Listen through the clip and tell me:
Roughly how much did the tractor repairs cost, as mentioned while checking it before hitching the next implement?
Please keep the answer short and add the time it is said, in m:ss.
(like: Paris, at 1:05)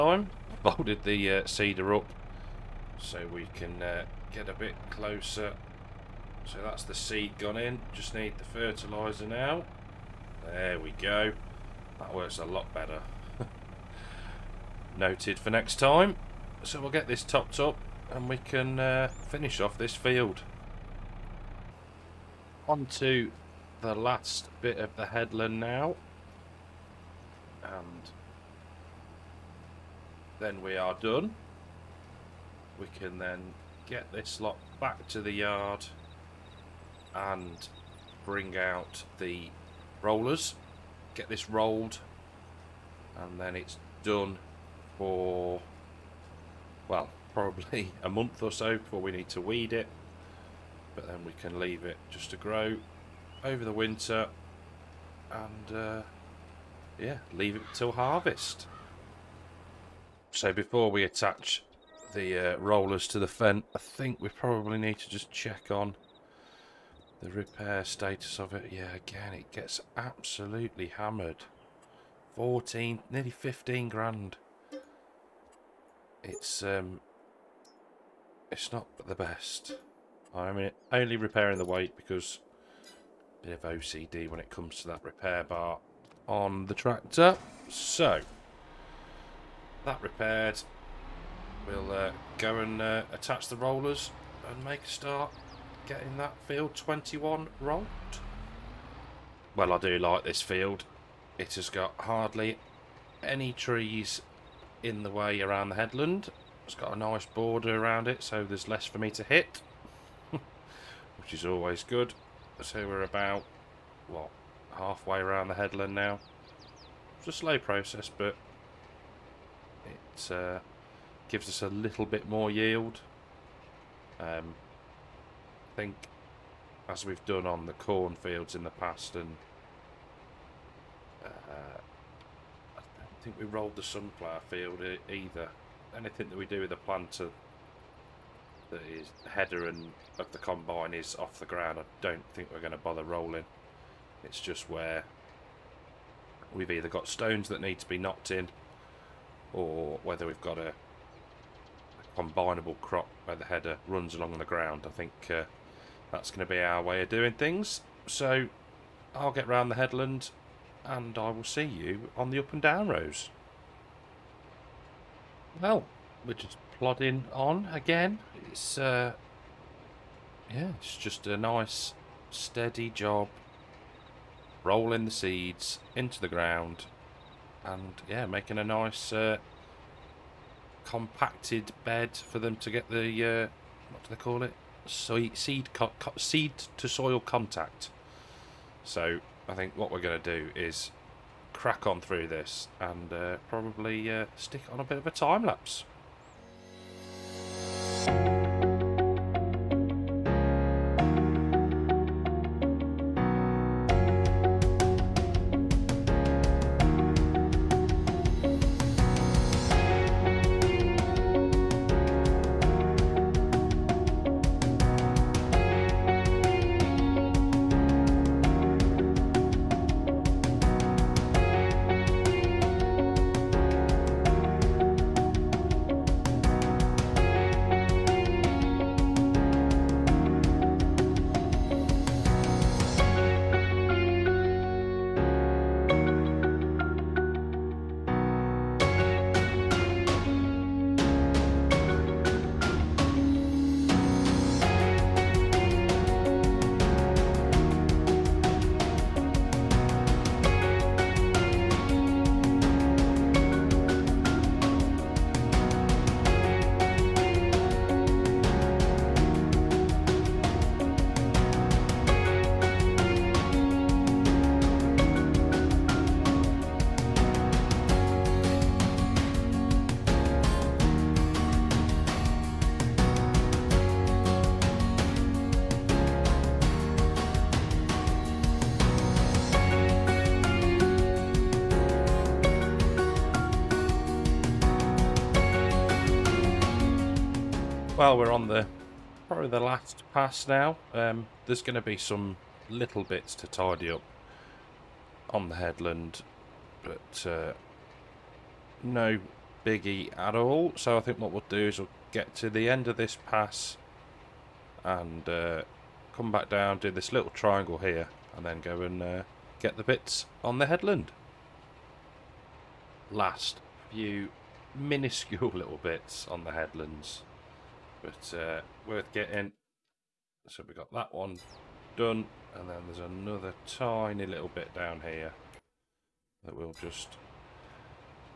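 nearly 15 grand, at 1:13.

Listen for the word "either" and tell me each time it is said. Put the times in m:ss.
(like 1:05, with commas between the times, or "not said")
2:15, 2:26.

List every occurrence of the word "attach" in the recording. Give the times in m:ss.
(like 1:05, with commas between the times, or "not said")
1:01, 1:33.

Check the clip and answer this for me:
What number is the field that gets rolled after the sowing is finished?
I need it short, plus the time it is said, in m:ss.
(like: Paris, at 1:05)
21, at 1:36.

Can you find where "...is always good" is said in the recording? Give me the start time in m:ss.
1:51.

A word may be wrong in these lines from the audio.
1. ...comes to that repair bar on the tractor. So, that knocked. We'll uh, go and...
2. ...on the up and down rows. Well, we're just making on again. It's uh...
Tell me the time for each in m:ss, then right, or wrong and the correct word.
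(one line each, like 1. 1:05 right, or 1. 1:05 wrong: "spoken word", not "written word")
1. 1:24 wrong: "repaired", not "knocked"
2. 2:42 wrong: "plodding", not "making".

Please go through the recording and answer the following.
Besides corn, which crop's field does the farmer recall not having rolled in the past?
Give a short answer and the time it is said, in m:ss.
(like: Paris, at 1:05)
sunflower, at 2:13.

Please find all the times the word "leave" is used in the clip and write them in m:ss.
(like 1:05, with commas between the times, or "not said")
0:51, 0:57.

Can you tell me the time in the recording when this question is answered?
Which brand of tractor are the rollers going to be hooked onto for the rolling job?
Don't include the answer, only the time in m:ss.
1:03.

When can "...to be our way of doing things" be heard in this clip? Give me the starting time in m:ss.
2:36.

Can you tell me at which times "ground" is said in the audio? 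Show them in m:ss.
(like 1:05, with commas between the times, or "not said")
2:21, 2:34, 2:56.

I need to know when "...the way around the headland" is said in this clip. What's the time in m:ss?
1:45.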